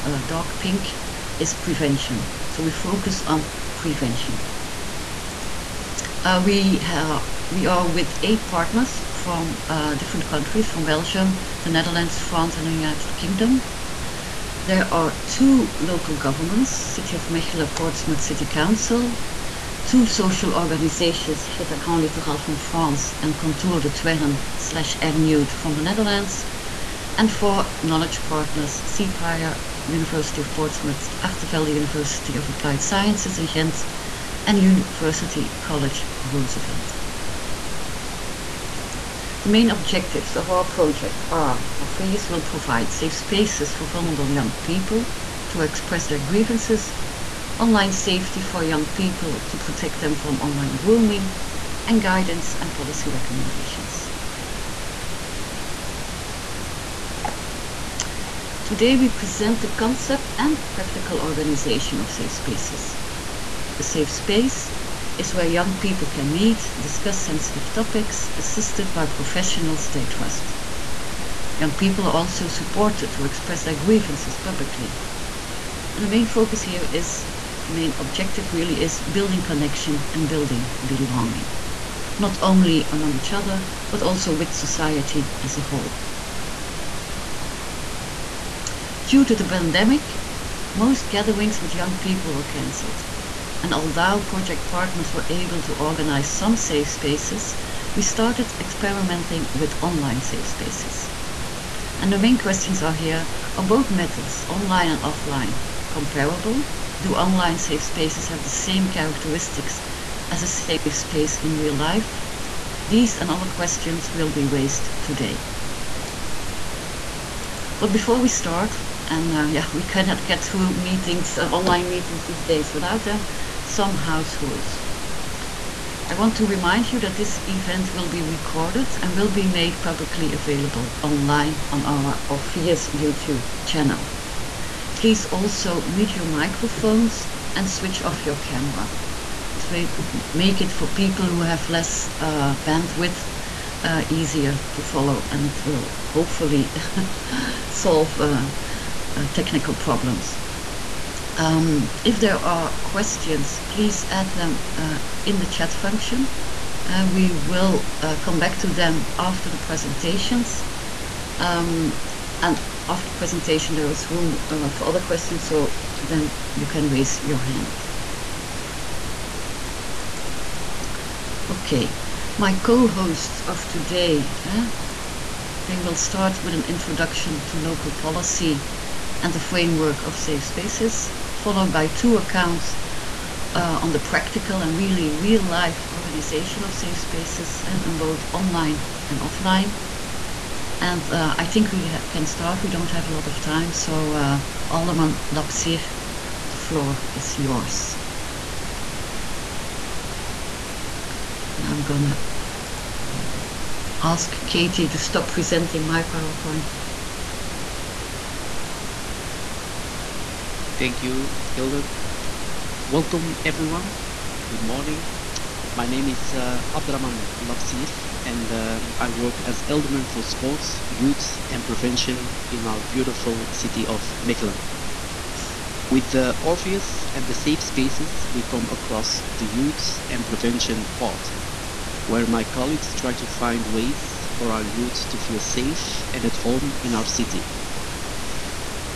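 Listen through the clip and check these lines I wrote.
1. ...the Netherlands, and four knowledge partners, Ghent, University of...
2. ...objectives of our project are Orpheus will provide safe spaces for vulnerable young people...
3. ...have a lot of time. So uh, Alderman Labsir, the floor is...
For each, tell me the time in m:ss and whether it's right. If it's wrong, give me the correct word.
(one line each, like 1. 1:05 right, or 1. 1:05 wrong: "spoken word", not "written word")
1. 0:25 wrong: "Ceapire", not "Ghent"
2. 0:39 right
3. 3:12 right.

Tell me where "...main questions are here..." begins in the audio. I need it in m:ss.
1:42.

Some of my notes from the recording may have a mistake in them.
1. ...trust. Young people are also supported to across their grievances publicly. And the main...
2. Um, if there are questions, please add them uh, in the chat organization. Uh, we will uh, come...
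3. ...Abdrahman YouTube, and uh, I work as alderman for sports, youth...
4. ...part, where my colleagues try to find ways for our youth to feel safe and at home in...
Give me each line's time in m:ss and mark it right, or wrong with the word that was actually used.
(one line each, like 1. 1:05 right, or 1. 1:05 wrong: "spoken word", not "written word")
1. 1:10 wrong: "express", not "across"
2. 2:31 wrong: "function", not "organization"
3. 3:36 wrong: "Labsir", not "YouTube"
4. 3:50 right.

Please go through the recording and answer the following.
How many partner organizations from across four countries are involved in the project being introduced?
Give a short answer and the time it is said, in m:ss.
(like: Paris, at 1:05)
8, at 0:08.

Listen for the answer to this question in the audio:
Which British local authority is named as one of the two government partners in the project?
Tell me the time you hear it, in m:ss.
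0:17.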